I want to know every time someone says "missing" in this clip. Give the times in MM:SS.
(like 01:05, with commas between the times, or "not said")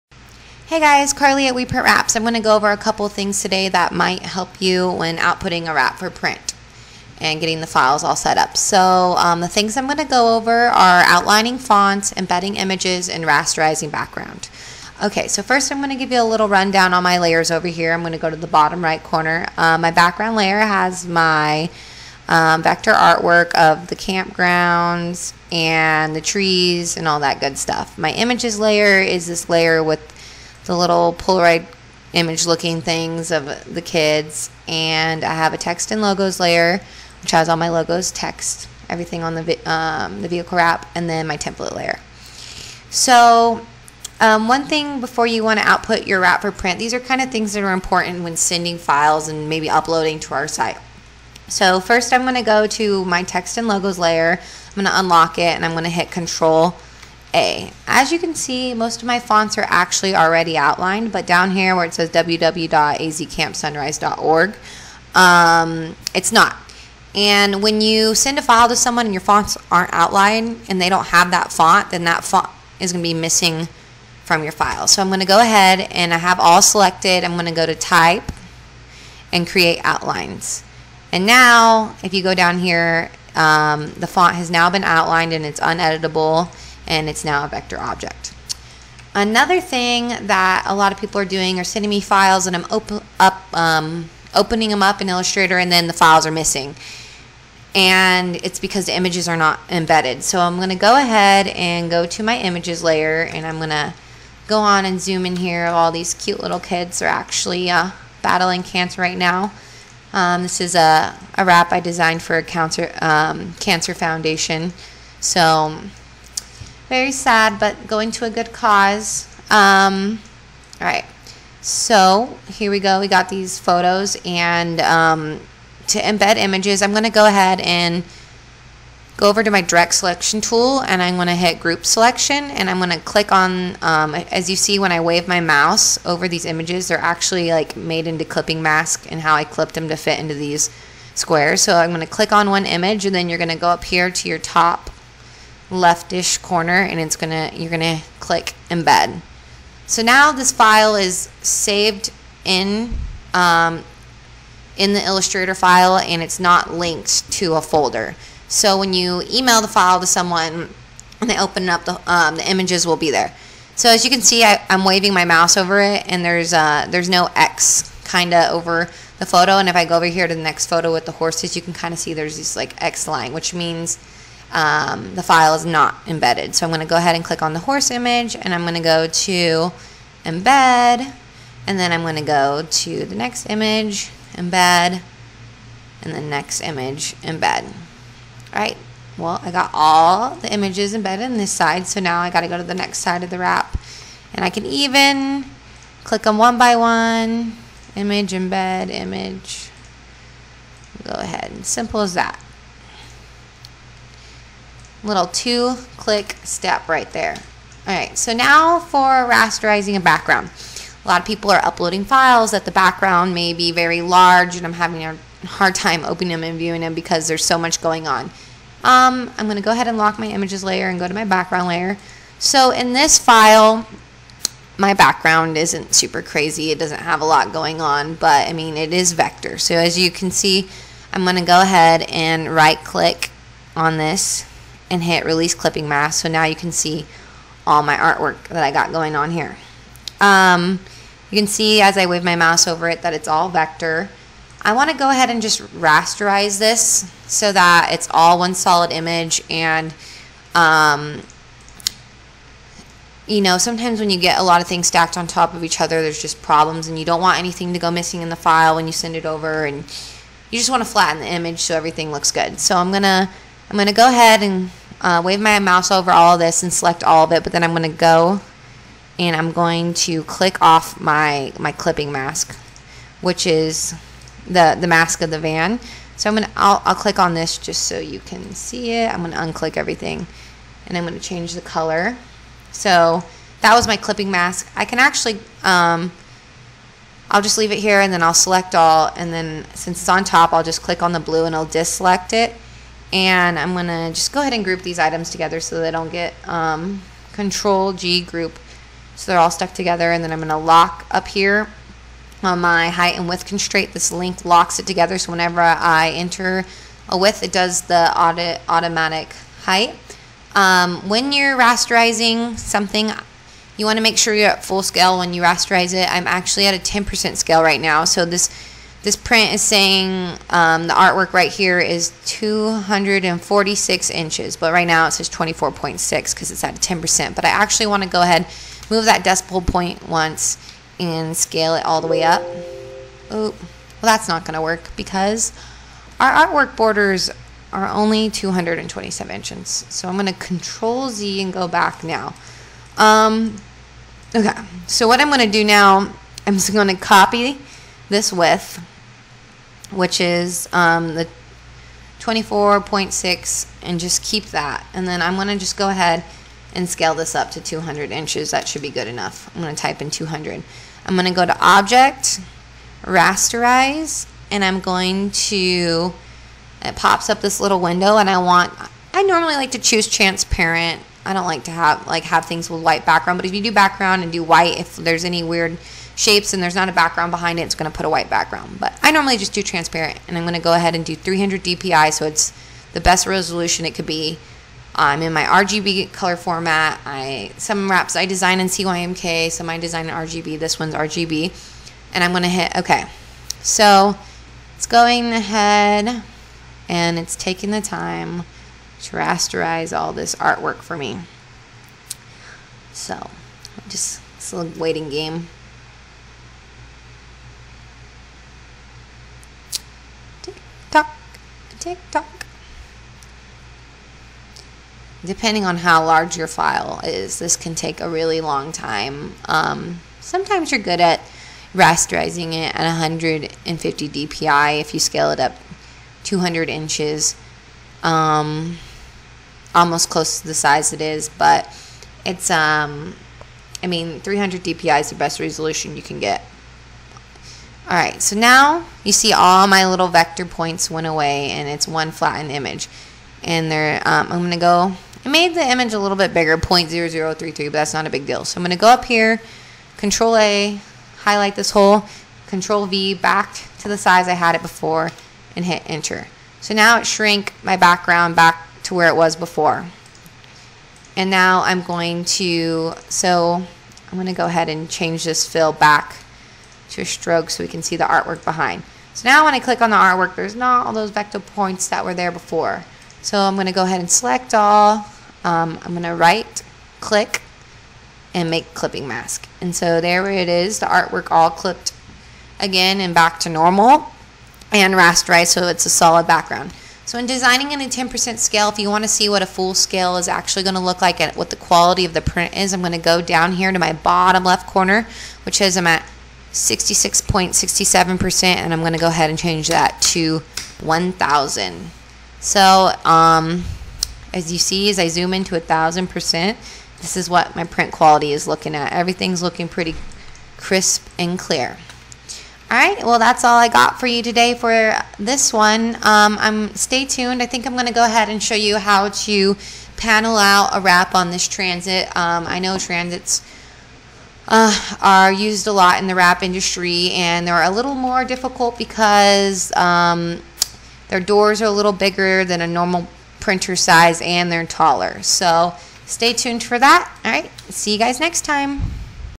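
01:13, 01:36, 04:17.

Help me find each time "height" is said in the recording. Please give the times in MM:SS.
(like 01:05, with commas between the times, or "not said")
05:02, 05:09.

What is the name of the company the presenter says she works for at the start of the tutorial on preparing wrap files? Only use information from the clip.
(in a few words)
We Print Wraps.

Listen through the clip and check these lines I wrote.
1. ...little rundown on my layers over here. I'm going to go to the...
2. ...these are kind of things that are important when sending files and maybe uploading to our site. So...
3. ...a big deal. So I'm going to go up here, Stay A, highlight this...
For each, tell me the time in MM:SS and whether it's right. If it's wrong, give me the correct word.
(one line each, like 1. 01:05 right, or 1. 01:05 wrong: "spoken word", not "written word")
1. 00:16 right
2. 00:46 right
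3. 07:28 wrong: "Control", not "Stay".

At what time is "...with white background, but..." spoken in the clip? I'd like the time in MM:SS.
06:12.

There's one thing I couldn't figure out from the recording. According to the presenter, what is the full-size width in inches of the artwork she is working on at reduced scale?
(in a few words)
246 inches.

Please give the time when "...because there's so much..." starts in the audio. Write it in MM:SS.
03:36.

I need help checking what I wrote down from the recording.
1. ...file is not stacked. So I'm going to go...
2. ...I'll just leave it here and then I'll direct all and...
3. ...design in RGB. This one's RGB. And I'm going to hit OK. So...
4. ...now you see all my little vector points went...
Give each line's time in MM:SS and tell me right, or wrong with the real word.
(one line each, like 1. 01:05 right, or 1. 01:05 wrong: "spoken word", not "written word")
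1. 02:55 wrong: "embedded", not "stacked"
2. 04:47 wrong: "select", not "direct"
3. 06:29 right
4. 07:18 right.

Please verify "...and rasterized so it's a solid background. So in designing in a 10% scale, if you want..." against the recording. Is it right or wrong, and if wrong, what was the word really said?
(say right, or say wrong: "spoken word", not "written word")
right.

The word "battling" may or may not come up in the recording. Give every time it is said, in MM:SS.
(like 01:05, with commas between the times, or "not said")
01:48.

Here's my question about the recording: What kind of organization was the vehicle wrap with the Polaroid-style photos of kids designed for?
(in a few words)
Cancer foundation.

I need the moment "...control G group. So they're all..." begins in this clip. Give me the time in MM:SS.
04:57.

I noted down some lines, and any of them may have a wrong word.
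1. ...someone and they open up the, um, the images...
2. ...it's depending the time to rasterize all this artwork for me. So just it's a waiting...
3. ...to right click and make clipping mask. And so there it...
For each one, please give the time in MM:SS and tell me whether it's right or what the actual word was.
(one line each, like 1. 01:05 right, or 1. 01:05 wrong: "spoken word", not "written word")
1. 02:40 right
2. 06:37 wrong: "taking", not "depending"
3. 07:56 right.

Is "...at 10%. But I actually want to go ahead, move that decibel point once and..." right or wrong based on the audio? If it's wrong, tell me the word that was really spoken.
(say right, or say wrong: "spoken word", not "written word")
right.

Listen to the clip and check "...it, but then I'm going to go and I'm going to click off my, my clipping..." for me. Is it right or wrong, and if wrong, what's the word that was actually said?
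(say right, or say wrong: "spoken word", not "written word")
right.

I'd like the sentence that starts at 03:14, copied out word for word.
And I can even click them one by one, image, embed, image.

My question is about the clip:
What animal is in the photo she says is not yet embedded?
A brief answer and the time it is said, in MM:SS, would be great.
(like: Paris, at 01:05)
Horses, at 02:51.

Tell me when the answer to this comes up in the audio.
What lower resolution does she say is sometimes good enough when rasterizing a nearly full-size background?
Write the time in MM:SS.
07:02.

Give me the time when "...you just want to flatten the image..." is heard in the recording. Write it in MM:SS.
04:20.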